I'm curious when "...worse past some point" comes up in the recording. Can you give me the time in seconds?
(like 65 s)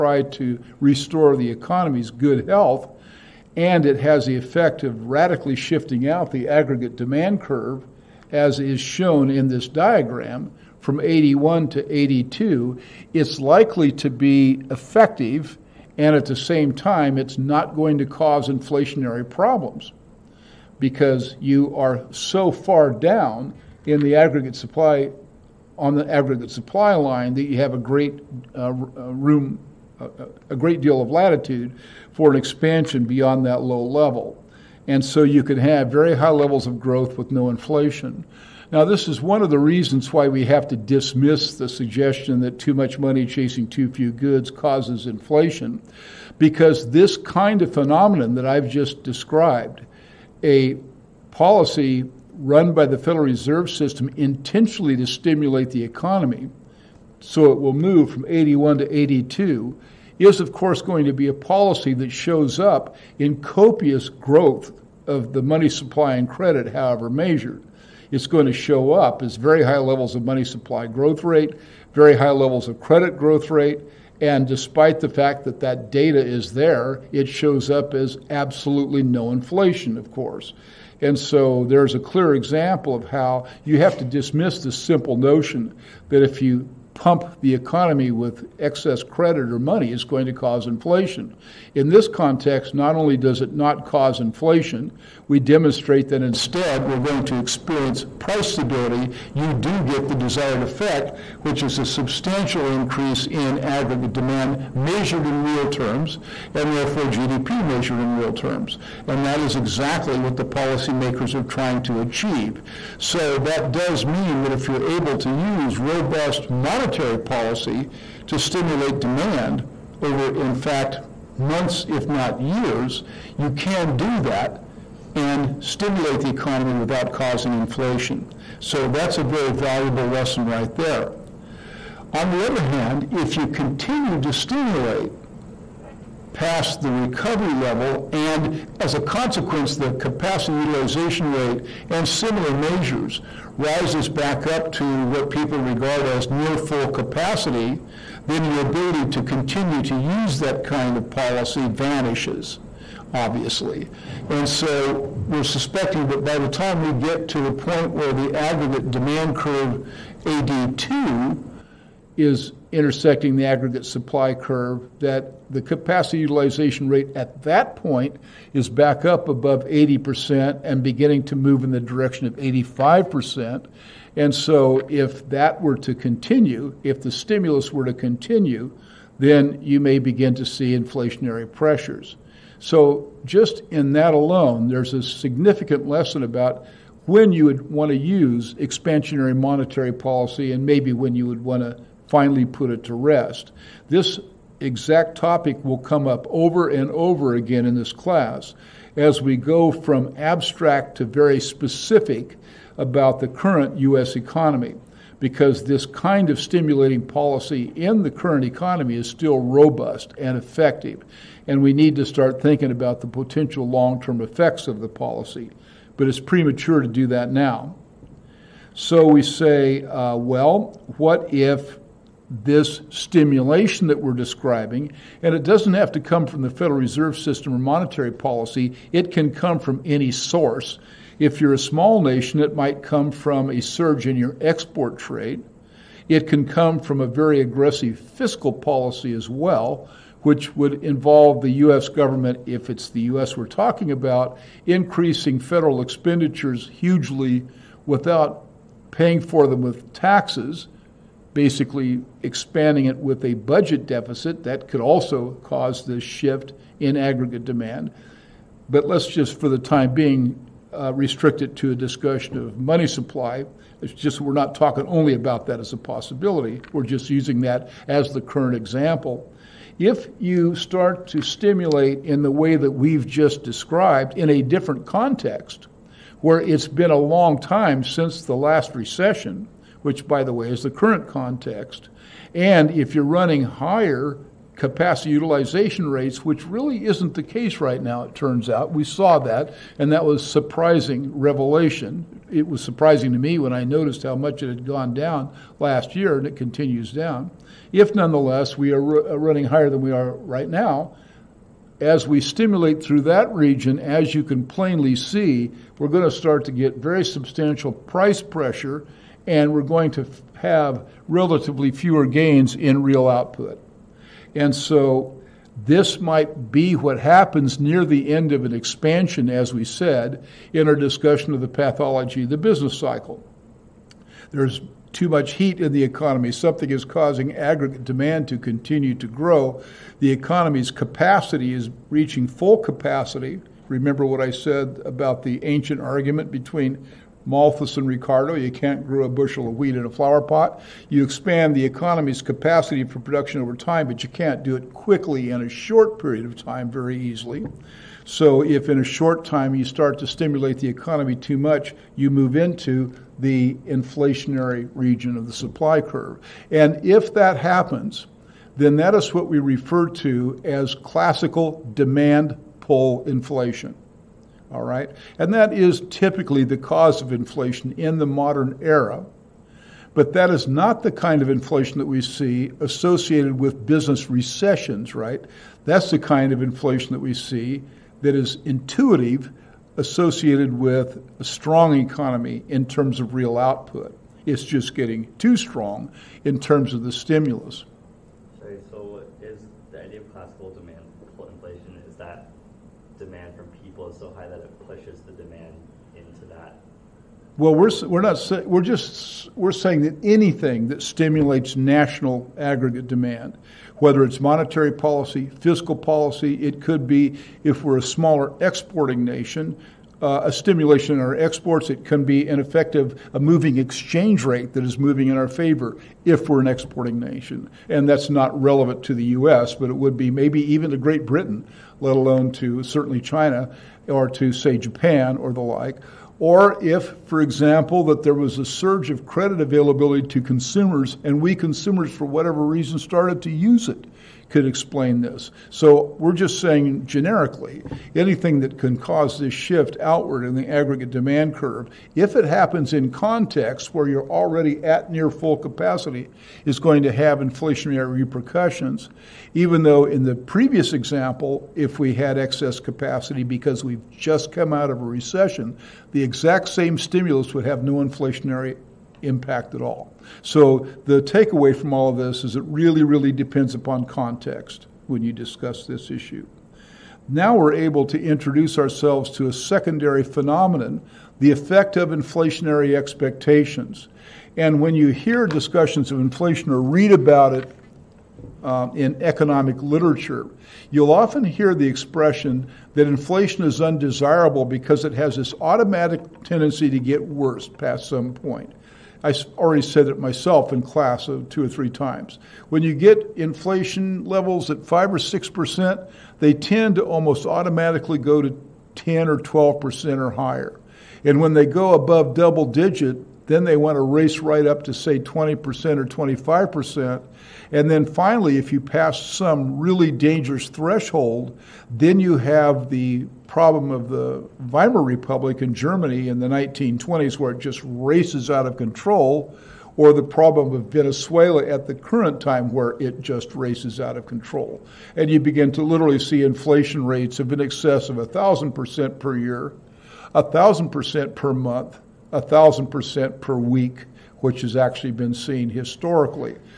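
487 s.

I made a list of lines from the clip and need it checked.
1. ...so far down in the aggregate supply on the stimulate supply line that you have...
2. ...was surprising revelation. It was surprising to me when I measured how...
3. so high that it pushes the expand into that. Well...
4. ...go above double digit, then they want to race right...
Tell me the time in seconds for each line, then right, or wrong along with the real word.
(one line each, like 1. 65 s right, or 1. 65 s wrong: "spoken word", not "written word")
1. 22 s wrong: "aggregate", not "stimulate"
2. 290 s wrong: "noticed", not "measured"
3. 394 s wrong: "demand", not "expand"
4. 501 s right.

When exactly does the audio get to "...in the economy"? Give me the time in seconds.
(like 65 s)
325 s.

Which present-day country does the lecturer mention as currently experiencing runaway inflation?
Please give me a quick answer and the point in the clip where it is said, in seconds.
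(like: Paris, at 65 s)
Venezuela, at 520 s.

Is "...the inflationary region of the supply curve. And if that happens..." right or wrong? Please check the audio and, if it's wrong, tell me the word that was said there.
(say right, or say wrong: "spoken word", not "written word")
right.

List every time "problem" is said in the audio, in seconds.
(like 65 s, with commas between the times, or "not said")
19 s, 513 s, 520 s.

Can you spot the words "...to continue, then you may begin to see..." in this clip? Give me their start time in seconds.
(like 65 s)
177 s.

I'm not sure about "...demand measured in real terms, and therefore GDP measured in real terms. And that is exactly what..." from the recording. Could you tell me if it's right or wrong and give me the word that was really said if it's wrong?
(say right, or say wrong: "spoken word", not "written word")
right.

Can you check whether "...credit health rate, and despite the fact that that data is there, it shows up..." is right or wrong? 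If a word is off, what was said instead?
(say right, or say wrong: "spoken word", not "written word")
wrong: "growth", not "health".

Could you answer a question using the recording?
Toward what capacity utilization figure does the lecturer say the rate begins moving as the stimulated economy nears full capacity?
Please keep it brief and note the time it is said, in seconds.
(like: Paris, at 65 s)
85%, at 172 s.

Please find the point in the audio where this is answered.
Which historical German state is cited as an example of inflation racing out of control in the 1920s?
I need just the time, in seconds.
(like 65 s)
514 s.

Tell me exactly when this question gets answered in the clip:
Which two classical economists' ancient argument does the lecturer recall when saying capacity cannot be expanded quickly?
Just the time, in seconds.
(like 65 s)
337 s.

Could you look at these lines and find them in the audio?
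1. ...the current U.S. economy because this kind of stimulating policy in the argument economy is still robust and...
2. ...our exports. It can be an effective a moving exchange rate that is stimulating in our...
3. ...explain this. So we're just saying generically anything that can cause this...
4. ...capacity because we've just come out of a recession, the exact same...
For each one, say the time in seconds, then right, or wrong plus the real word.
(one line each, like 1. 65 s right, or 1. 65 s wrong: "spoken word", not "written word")
1. 203 s wrong: "current", not "argument"
2. 411 s wrong: "moving", not "stimulating"
3. 434 s right
4. 452 s right.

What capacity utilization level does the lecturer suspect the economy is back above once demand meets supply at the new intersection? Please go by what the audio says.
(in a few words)
80%.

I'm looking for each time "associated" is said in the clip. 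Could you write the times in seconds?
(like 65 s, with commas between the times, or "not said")
372 s, 379 s.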